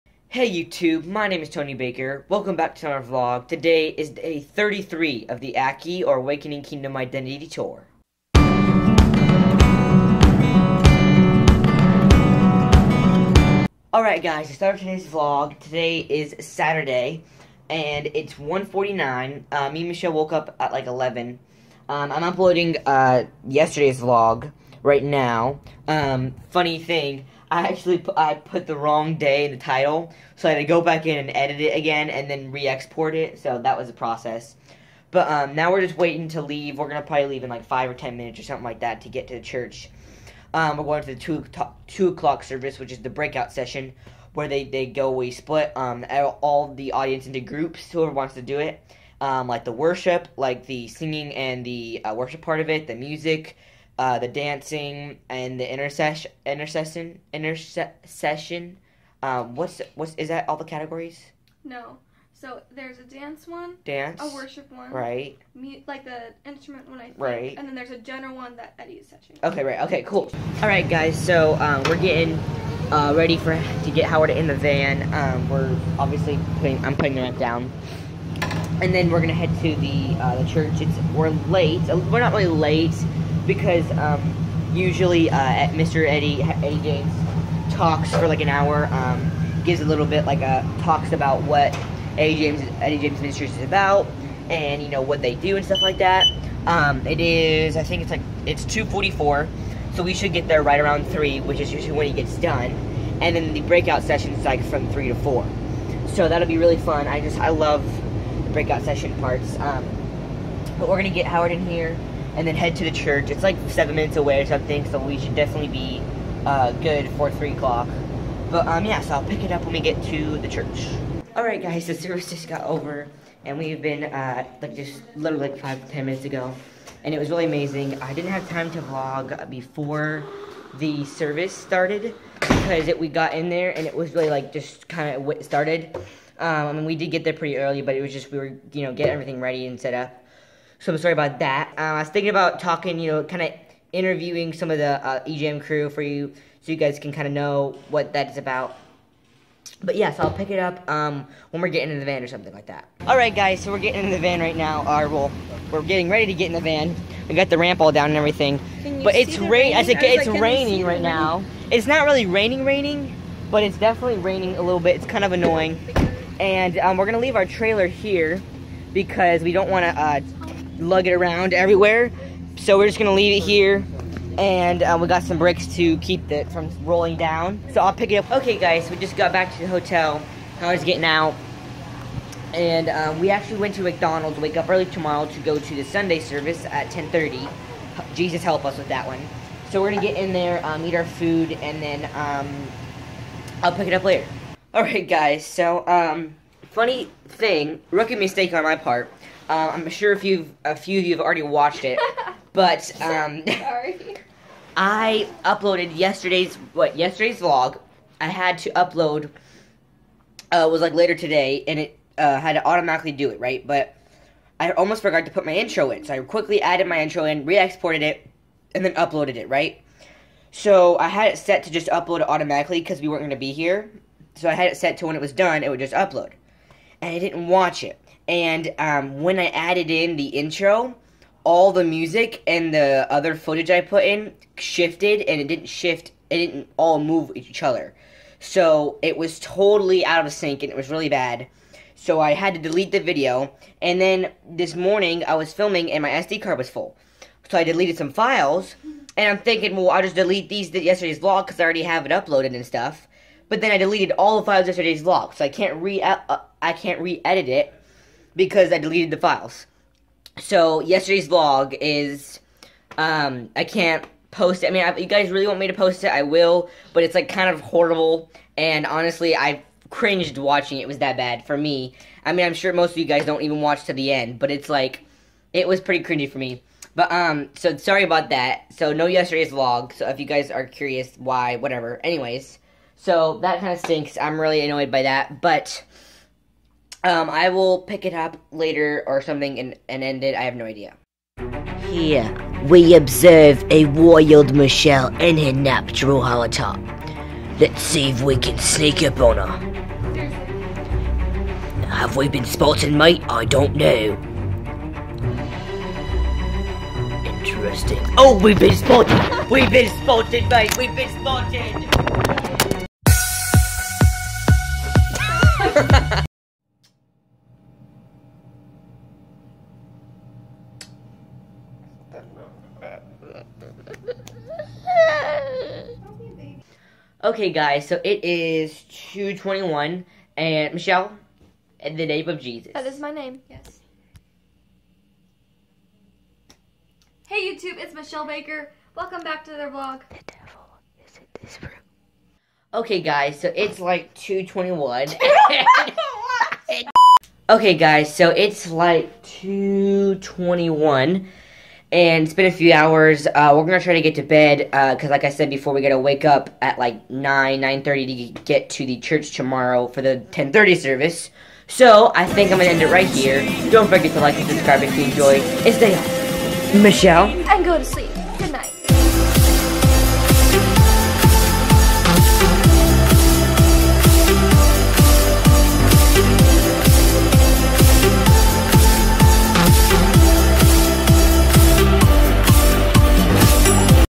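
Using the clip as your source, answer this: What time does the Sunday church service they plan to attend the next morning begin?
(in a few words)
10:30.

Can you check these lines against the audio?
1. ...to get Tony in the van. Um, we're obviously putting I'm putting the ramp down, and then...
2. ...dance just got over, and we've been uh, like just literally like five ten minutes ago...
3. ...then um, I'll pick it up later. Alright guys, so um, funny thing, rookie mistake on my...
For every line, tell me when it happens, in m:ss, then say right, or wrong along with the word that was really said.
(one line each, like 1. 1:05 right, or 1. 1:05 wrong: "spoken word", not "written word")
1. 1:13 wrong: "Howard", not "Tony"
2. 2:01 wrong: "service", not "dance"
3. 3:11 right.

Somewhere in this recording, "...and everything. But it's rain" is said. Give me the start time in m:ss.
2:38.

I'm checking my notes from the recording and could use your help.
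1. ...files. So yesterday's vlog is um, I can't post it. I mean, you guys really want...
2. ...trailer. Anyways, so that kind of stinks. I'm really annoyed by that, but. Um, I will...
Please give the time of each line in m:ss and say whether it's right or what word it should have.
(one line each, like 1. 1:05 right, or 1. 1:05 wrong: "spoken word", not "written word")
1. 4:19 right
2. 4:41 wrong: "whatever", not "trailer".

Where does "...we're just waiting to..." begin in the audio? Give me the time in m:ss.
0:35.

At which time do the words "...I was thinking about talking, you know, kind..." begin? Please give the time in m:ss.
2:21.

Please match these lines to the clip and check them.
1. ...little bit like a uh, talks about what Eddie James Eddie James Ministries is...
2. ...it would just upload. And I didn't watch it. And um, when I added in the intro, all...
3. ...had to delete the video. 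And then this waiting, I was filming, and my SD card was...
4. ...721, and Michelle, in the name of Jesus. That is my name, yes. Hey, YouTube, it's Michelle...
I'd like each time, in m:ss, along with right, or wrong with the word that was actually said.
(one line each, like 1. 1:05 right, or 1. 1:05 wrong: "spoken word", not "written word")
1. 1:29 right
2. 3:45 right
3. 4:02 wrong: "morning", not "waiting"
4. 5:29 wrong: "221", not "721".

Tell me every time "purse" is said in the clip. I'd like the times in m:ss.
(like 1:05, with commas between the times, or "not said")
not said.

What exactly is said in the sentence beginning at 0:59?
Um, what's what's is that all the categories?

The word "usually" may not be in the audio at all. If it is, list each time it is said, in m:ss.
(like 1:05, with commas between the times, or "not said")
1:24, 1:41.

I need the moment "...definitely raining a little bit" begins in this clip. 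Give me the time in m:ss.
2:43.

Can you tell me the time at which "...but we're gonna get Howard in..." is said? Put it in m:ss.
1:50.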